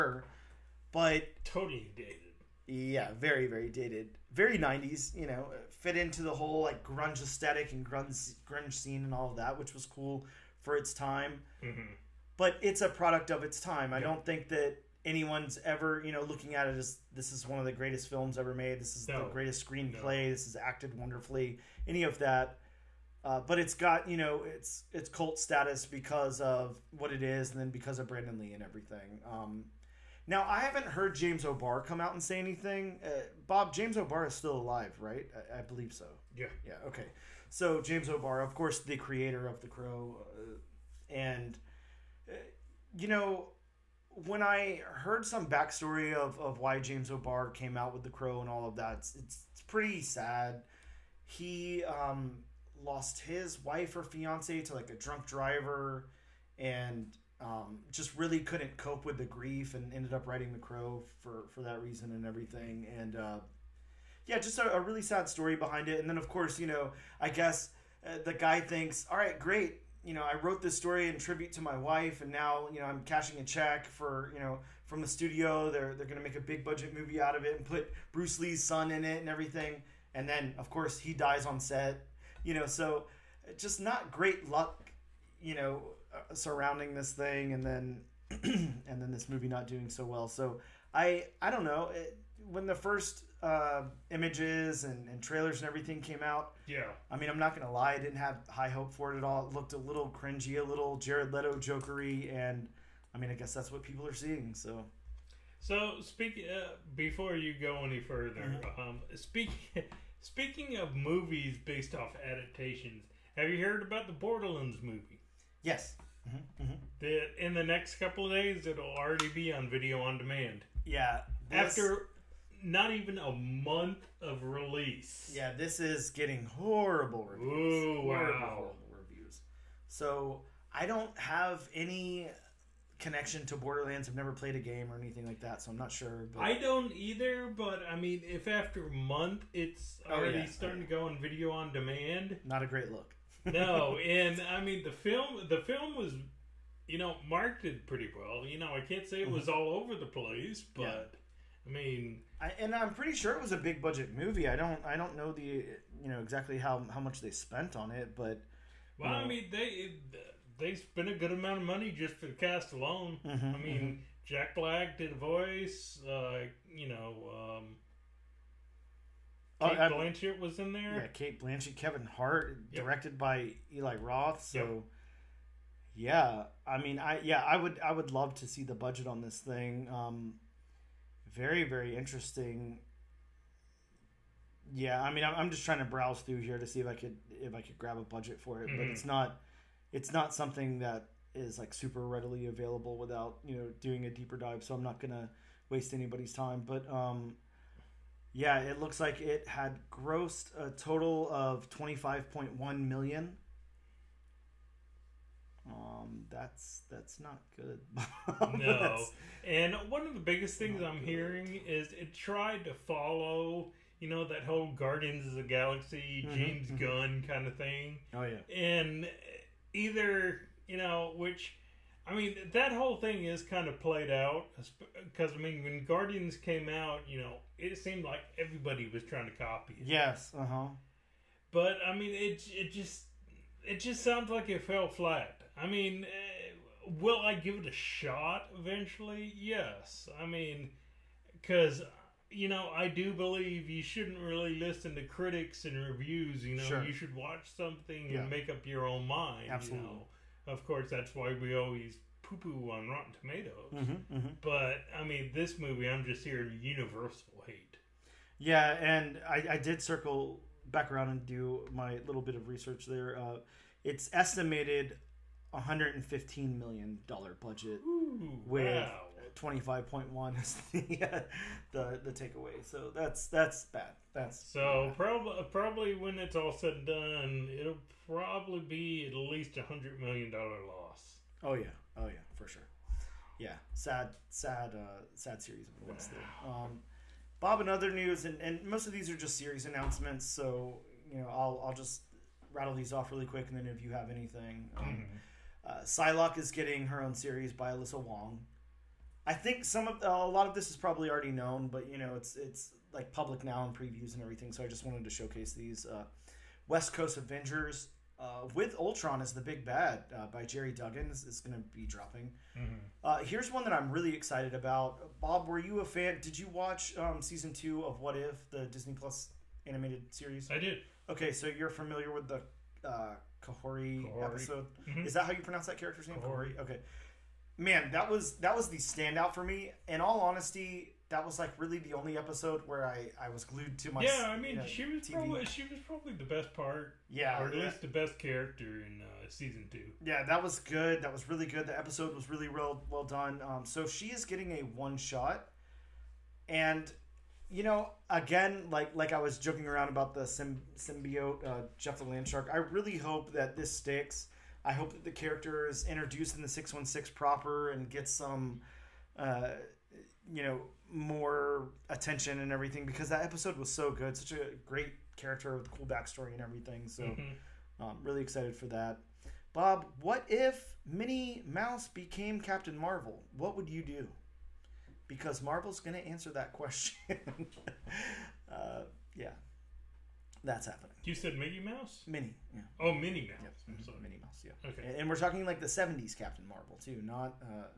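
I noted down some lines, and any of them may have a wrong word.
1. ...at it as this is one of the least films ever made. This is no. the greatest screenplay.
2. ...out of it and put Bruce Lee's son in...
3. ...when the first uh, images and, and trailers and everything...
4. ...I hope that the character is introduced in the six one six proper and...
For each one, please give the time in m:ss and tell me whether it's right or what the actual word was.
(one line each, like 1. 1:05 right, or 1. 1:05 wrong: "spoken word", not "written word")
1. 0:16 wrong: "greatest", not "least"
2. 1:17 right
3. 1:32 right
4. 5:54 right.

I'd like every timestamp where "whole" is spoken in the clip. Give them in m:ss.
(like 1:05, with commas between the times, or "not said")
0:06, 3:34, 3:42.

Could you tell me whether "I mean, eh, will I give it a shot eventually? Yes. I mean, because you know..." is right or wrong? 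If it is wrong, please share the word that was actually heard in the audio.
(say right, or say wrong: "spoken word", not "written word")
right.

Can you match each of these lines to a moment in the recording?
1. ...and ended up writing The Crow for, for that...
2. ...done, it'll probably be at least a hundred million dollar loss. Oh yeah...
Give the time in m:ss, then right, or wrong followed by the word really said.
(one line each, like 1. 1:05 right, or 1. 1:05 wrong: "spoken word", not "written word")
1. 0:59 right
2. 4:36 right.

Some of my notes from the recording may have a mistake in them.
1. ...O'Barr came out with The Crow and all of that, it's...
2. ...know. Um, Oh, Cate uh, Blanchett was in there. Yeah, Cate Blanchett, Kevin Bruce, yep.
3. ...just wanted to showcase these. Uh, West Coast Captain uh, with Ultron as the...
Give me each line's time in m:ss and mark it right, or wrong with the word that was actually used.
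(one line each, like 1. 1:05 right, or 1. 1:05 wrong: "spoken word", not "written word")
1. 0:47 right
2. 2:46 wrong: "Hart", not "Bruce"
3. 5:04 wrong: "Avengers", not "Captain".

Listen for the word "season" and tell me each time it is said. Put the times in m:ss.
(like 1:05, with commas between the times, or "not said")
5:17, 5:39.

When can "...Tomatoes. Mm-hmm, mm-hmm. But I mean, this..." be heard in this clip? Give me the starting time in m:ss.
4:13.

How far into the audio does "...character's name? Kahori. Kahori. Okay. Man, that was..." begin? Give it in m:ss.
5:25.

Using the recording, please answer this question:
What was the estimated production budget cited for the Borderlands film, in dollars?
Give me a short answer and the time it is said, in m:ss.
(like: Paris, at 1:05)
115 million, at 4:25.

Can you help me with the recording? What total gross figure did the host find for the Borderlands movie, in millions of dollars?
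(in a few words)
25.1 million.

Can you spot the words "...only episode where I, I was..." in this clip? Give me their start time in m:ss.
5:31.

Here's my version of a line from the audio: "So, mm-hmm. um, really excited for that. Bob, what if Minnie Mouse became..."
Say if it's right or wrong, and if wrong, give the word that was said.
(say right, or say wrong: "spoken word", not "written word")
right.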